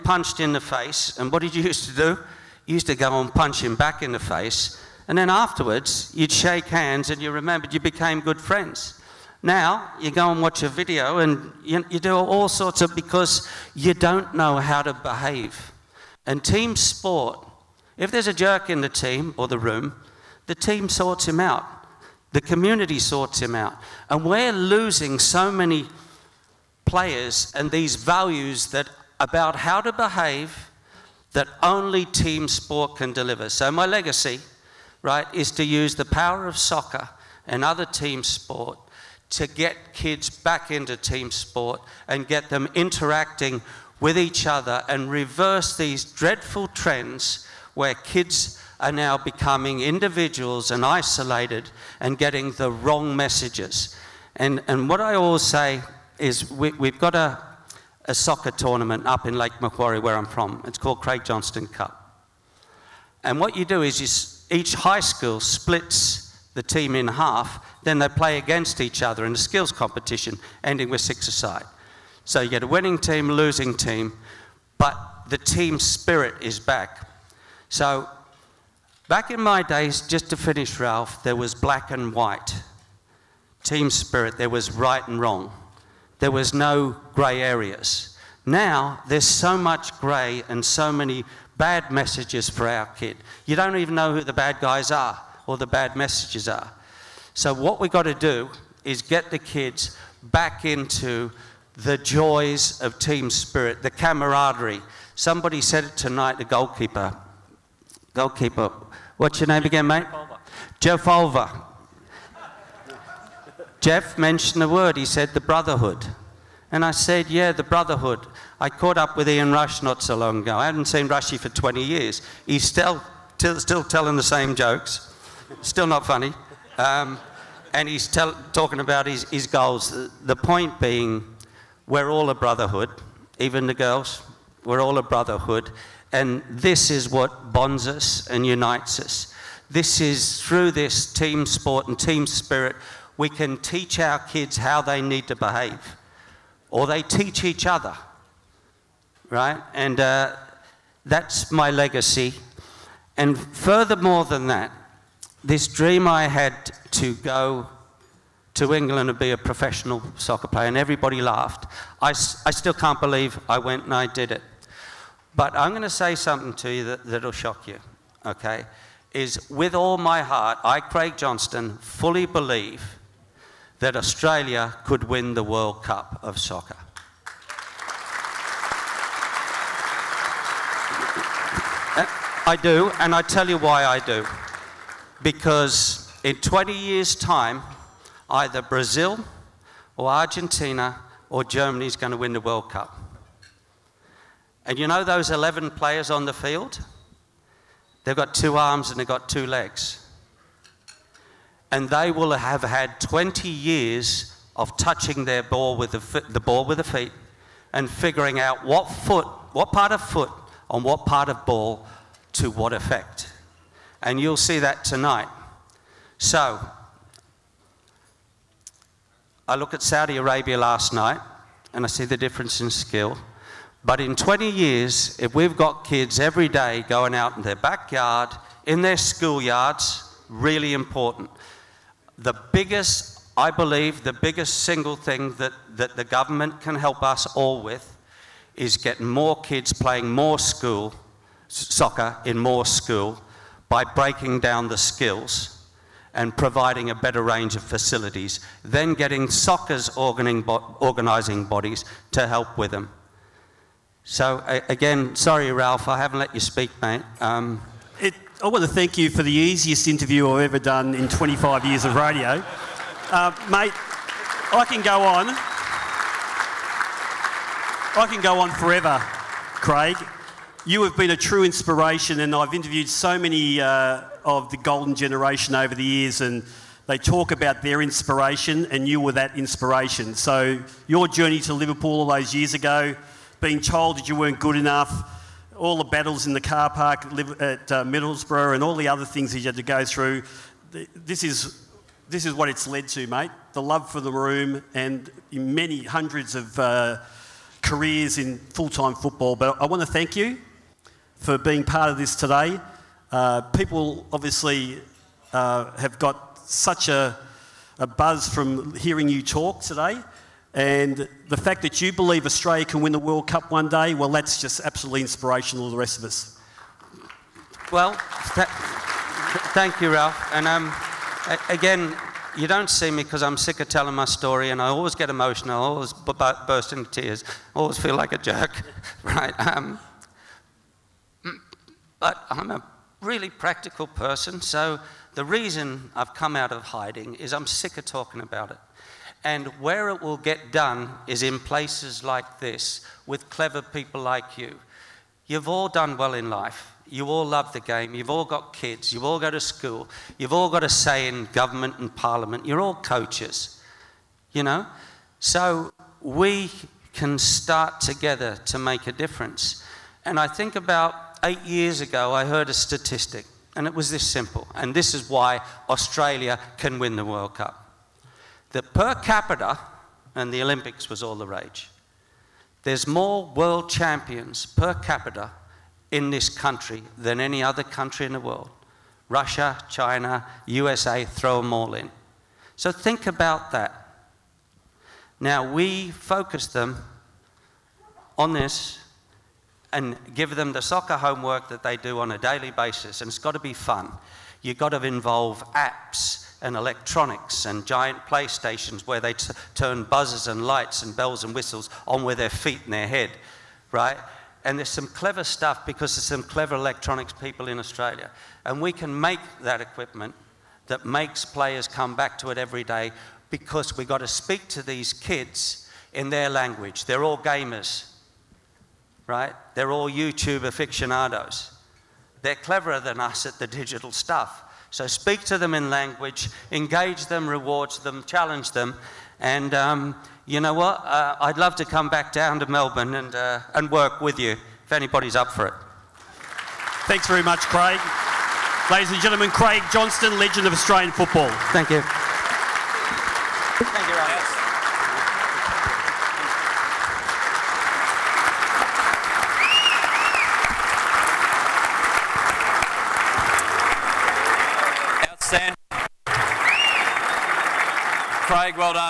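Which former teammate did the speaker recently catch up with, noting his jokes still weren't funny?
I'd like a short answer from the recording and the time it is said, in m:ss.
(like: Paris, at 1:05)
Ian Rush, at 1:59.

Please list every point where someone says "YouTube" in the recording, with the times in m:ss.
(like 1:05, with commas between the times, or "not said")
6:59.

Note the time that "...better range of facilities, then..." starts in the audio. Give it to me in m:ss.
4:06.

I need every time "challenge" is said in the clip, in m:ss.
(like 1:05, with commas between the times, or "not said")
7:08.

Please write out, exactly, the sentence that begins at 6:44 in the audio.
And there's some clever stuff because there's some clever electronics people in Australia.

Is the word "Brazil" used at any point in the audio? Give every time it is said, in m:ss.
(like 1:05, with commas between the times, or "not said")
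3:08.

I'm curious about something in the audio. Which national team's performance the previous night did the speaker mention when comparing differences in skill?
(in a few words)
Saudi Arabia.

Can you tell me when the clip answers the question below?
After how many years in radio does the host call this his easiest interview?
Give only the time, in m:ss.
4:21.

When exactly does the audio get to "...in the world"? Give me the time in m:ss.
6:18.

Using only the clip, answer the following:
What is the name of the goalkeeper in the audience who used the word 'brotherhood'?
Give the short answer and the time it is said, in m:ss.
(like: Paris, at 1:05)
Jeff Folver, at 1:50.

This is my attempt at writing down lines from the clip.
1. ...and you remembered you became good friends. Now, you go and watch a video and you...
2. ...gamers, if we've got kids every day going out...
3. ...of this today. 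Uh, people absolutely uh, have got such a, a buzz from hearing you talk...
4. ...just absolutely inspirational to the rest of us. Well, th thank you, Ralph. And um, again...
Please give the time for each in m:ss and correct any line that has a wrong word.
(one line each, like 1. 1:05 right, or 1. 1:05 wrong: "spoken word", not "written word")
1. 0:07 right
2. 3:44 wrong: "years", not "gamers"
3. 5:01 wrong: "obviously", not "absolutely"
4. 5:14 right.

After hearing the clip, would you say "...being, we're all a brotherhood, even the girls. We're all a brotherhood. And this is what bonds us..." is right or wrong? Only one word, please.
right.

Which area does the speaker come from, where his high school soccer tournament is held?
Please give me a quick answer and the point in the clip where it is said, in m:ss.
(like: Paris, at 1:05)
Lake Macquarie, at 0:59.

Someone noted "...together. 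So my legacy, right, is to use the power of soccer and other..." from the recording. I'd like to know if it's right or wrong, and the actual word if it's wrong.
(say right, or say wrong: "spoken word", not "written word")
wrong: "deliver", not "together".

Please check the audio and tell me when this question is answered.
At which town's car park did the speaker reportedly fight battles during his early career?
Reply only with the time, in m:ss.
4:47.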